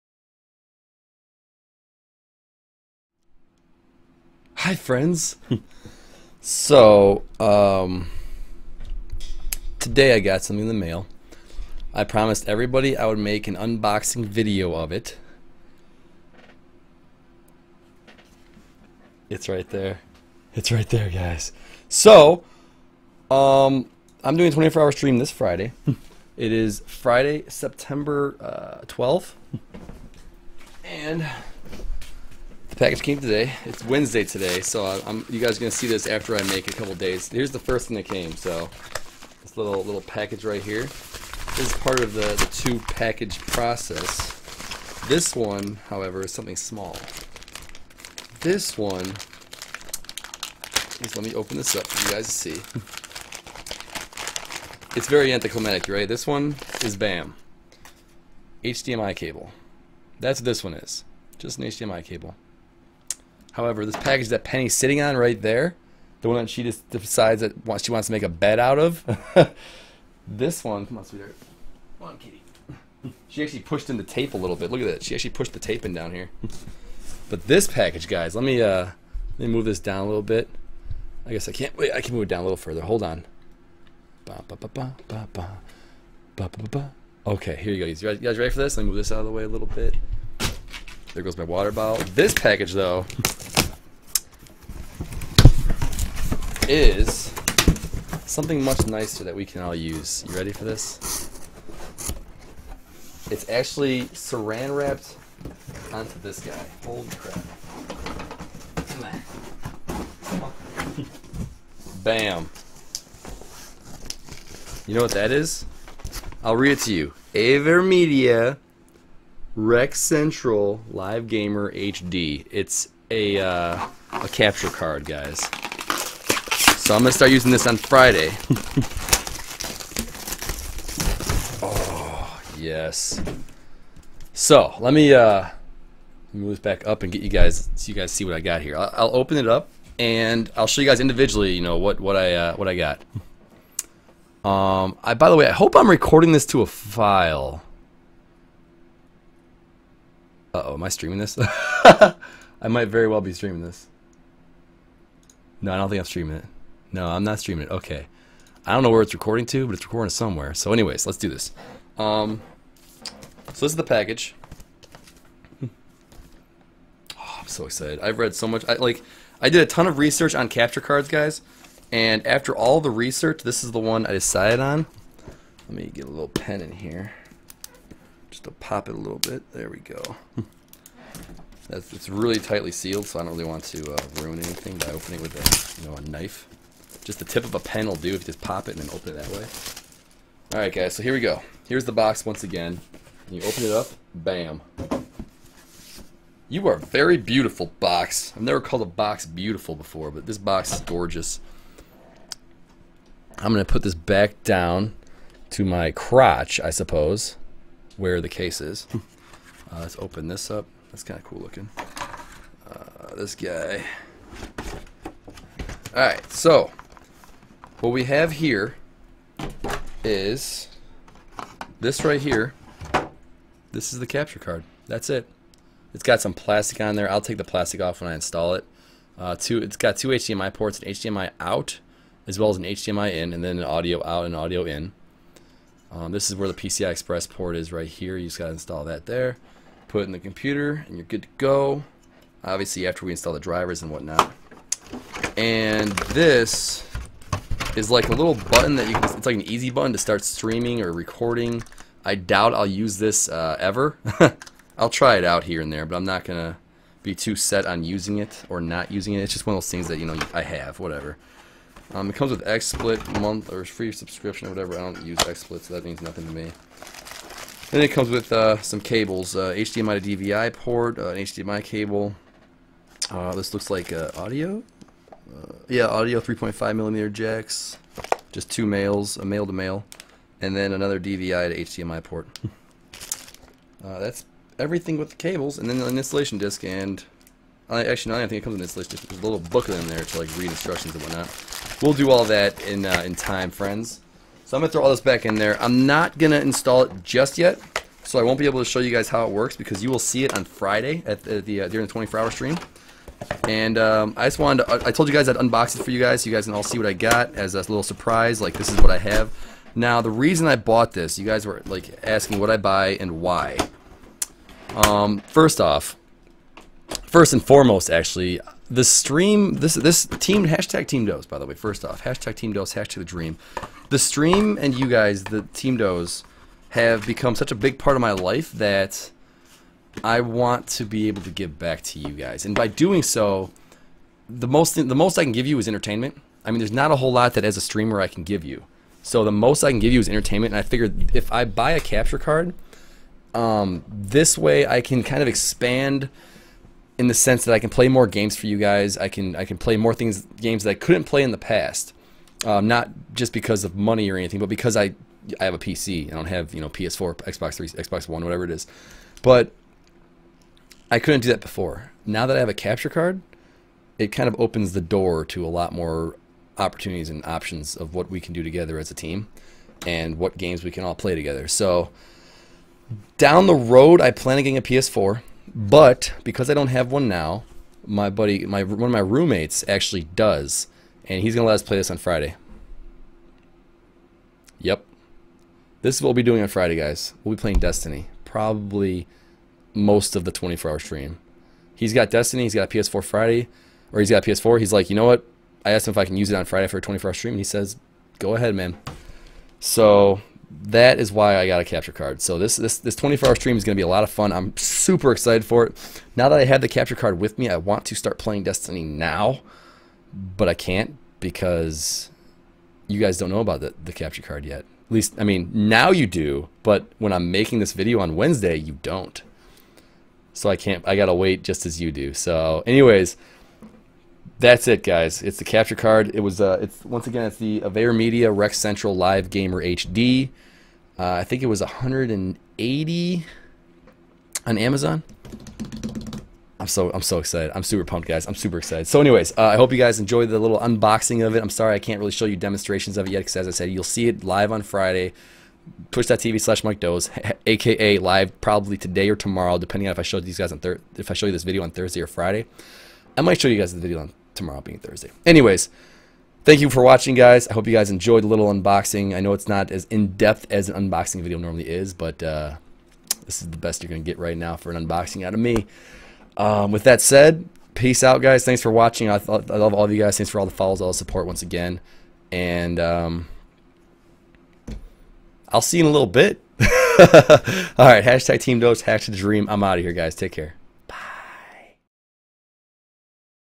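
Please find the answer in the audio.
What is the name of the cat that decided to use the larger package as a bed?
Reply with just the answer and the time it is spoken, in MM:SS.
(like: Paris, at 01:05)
Penny, at 01:04.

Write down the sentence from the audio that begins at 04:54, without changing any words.
So I'm gonna throw all this back in there.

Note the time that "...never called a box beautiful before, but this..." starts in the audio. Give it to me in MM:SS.
03:18.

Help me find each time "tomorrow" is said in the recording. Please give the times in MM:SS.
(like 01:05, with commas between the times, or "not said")
07:29, 07:34.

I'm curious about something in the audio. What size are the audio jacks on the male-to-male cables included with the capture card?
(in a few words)
3.5 millimeter.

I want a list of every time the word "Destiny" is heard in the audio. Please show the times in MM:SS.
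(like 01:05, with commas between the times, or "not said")
06:27, 06:32, 06:48.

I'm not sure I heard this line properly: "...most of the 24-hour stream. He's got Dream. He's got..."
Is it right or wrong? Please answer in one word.
wrong.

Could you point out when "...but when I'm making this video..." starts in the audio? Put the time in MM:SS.
06:56.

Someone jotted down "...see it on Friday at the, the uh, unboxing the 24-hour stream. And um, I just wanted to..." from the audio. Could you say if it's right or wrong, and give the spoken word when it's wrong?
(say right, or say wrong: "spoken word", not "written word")
wrong: "during", not "unboxing".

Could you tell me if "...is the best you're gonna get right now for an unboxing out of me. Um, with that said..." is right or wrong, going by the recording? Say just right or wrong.
right.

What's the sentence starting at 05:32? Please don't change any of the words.
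And by doing so, the most the most I can give you is entertainment.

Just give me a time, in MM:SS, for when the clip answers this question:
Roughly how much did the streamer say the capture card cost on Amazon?
07:11.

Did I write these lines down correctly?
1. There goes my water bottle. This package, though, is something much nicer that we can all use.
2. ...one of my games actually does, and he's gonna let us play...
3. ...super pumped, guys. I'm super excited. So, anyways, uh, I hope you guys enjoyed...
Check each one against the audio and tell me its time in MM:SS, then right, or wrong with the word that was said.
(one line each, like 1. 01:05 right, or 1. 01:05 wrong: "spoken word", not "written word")
1. 01:31 right
2. 06:18 wrong: "roommates", not "games"
3. 07:17 right.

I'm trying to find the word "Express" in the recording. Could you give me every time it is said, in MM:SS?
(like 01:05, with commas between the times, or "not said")
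03:56.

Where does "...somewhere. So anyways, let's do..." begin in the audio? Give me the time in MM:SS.
02:40.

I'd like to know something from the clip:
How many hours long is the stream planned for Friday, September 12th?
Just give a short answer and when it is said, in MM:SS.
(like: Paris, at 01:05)
24, at 00:24.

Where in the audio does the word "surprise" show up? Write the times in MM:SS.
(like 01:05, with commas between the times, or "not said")
05:07.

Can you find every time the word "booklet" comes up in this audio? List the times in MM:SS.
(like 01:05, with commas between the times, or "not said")
04:49.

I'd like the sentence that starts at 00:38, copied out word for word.
So this little little package right here.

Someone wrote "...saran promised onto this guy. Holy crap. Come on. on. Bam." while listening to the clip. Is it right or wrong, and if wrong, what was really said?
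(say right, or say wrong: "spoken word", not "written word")
wrong: "wrapped", not "promised".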